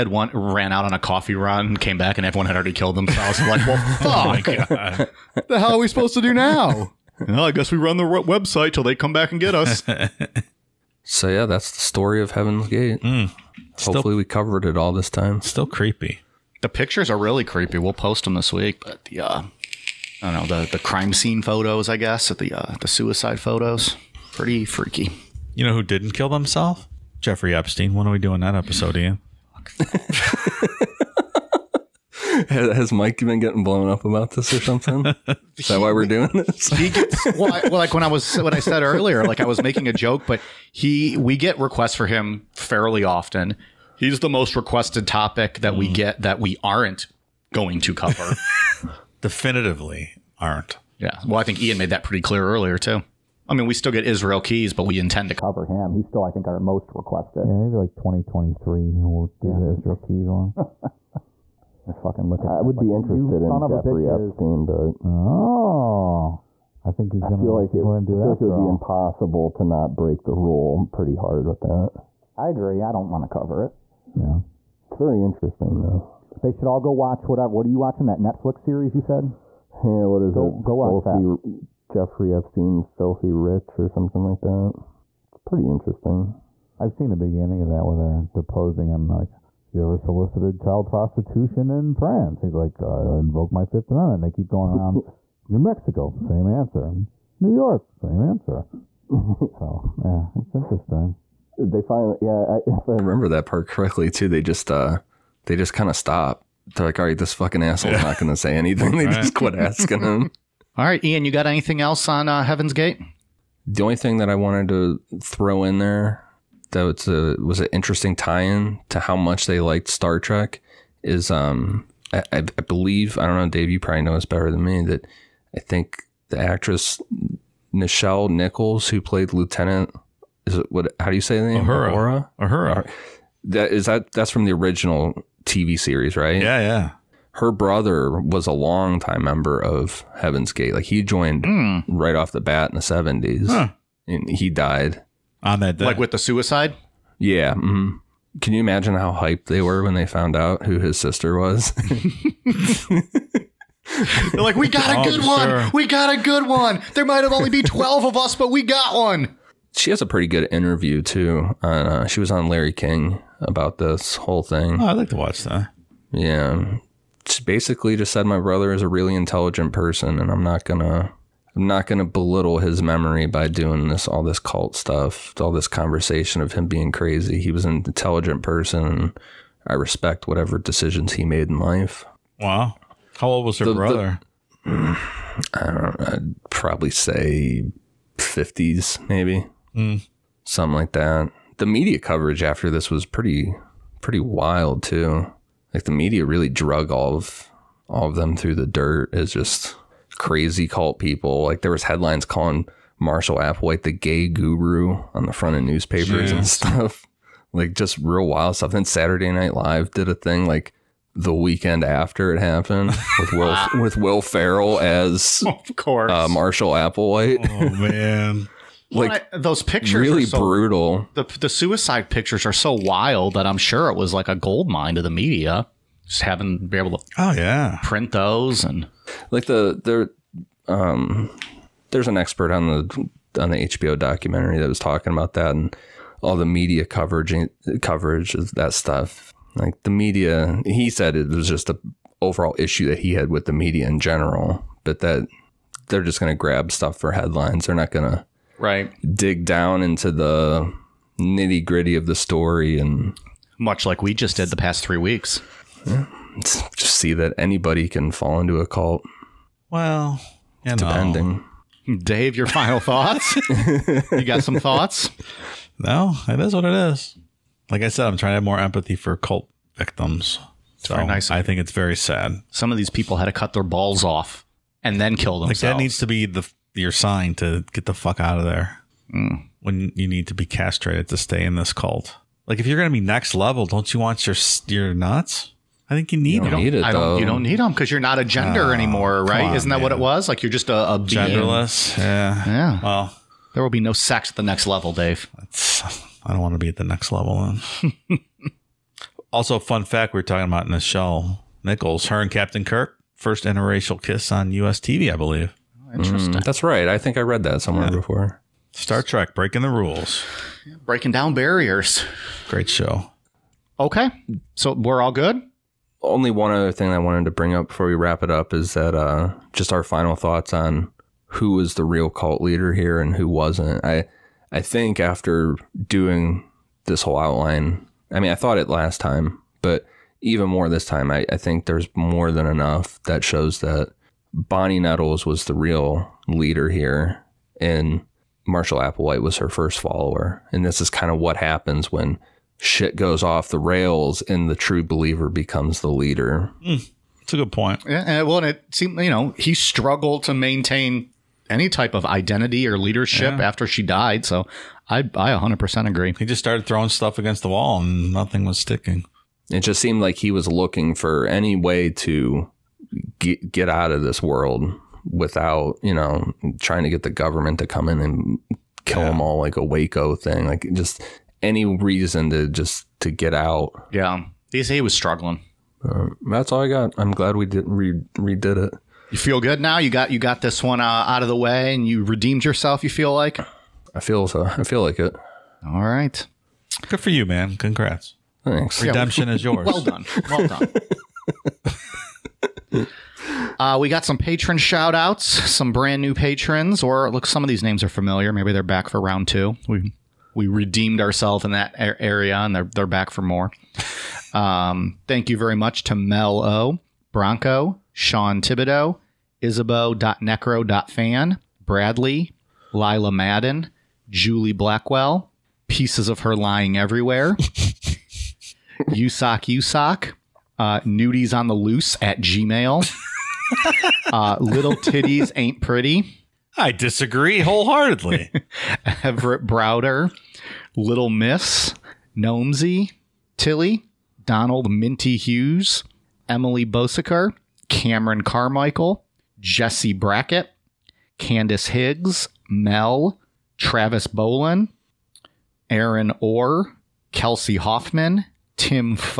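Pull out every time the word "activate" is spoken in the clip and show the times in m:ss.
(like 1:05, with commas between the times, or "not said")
not said.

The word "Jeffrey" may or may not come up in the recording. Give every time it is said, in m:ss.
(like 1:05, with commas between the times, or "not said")
0:27, 1:03, 1:21.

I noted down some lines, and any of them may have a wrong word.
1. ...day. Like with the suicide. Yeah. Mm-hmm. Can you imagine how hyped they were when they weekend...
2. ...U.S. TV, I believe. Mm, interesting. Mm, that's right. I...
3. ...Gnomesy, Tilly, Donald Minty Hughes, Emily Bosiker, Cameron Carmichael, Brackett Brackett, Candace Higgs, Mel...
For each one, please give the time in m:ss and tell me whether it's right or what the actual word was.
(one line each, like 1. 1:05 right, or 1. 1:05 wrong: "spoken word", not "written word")
1. 2:25 wrong: "found", not "weekend"
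2. 5:04 right
3. 7:12 wrong: "Jesse", not "Brackett".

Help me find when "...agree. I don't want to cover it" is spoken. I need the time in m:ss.
1:12.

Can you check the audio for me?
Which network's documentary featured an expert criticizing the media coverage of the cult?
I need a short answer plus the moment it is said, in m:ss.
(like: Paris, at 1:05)
HBO, at 3:53.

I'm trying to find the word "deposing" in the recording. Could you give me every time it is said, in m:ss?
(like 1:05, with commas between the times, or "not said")
1:28.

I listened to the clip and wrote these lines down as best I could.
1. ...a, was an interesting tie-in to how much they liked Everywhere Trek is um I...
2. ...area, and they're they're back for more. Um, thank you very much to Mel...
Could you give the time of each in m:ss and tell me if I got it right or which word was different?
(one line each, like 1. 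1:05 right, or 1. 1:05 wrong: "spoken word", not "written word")
1. 1:57 wrong: "Star", not "Everywhere"
2. 6:41 right.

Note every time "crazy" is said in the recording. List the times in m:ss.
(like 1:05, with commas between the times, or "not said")
2:56, 3:20.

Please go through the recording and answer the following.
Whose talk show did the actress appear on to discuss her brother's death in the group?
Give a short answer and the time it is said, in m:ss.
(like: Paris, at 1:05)
Larry King, at 2:42.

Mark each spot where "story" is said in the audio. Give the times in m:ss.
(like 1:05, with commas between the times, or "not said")
0:11, 4:12.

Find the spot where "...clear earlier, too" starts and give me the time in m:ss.
0:52.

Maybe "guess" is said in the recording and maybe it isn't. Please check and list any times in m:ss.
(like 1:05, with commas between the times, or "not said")
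0:07, 0:21.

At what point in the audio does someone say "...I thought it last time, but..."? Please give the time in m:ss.
5:28.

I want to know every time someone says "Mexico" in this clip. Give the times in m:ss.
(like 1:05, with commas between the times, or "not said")
1:35.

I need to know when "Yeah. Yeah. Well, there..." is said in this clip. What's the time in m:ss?
4:52.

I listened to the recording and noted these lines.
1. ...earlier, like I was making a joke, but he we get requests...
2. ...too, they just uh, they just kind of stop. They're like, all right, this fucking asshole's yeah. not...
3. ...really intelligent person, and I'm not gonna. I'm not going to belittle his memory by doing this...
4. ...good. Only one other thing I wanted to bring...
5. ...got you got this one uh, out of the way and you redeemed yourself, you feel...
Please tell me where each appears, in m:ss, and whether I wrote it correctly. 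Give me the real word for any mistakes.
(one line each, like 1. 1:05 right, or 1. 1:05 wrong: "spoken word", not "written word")
1. 0:38 right
2. 1:44 right
3. 2:48 right
4. 5:15 right
5. 6:19 right.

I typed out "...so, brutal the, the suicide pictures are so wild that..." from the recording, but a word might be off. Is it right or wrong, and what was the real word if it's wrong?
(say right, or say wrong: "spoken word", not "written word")
right.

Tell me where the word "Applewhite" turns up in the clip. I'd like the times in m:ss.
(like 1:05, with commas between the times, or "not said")
3:23, 3:36, 5:38.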